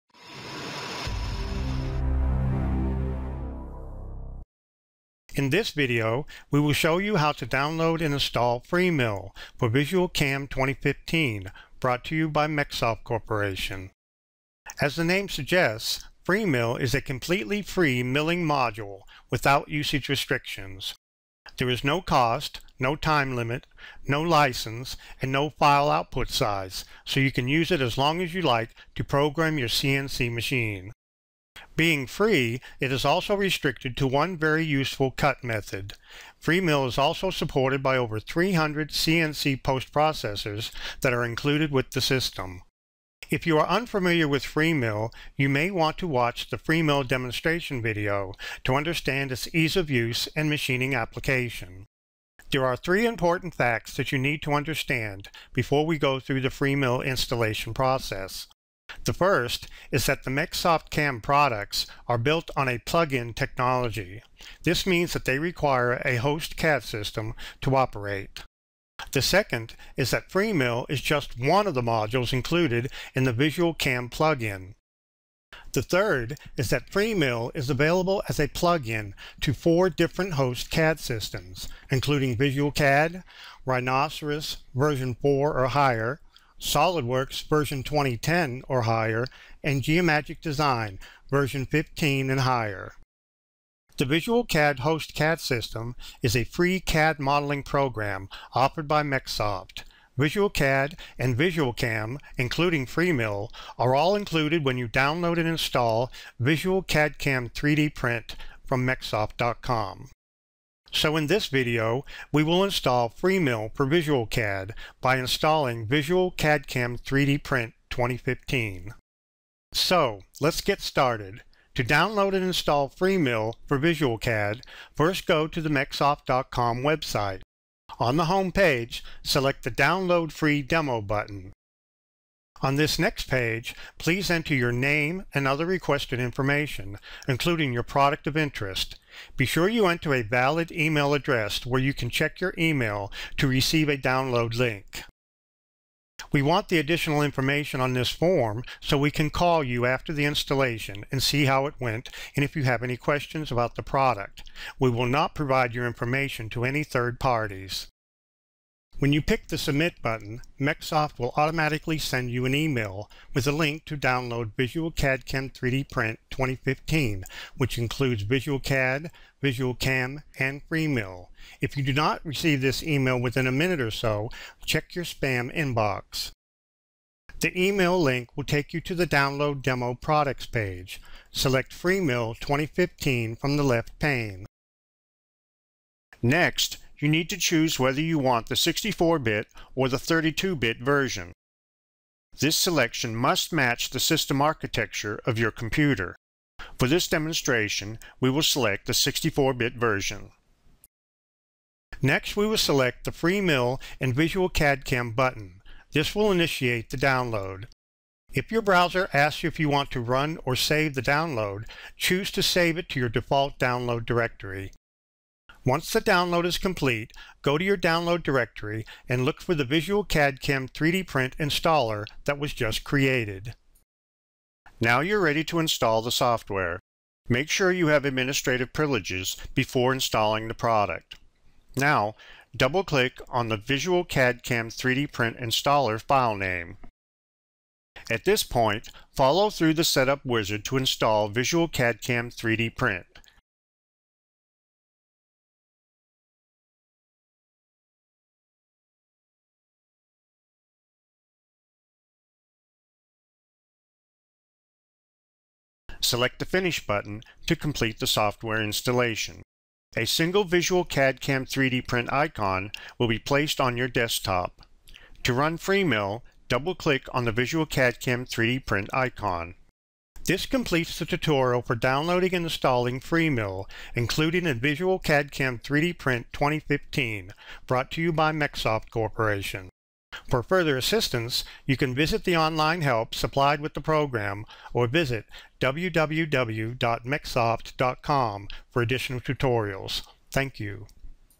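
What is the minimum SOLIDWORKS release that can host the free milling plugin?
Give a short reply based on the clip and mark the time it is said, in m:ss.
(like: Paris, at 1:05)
2010, at 1:27.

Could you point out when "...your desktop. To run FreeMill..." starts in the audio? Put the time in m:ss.
4:23.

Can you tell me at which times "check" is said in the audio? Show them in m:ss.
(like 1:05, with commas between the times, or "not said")
2:22, 2:54.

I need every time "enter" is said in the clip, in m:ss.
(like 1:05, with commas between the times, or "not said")
2:14, 2:19.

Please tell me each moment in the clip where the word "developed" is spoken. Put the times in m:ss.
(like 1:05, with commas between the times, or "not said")
not said.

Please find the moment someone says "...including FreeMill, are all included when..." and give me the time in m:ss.
1:42.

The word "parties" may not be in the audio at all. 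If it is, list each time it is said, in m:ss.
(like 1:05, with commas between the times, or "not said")
2:37.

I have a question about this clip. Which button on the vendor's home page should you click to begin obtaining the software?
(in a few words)
Download Free Demo.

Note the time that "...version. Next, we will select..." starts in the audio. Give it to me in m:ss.
3:19.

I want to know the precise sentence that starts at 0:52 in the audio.
There are three important facts that you need to understand before we go through the FreeMill installation process.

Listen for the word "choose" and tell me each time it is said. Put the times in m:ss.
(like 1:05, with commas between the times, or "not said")
3:07, 3:31.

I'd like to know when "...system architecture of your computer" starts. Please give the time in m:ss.
3:13.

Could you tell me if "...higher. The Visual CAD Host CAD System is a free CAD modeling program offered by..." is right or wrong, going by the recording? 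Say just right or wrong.
right.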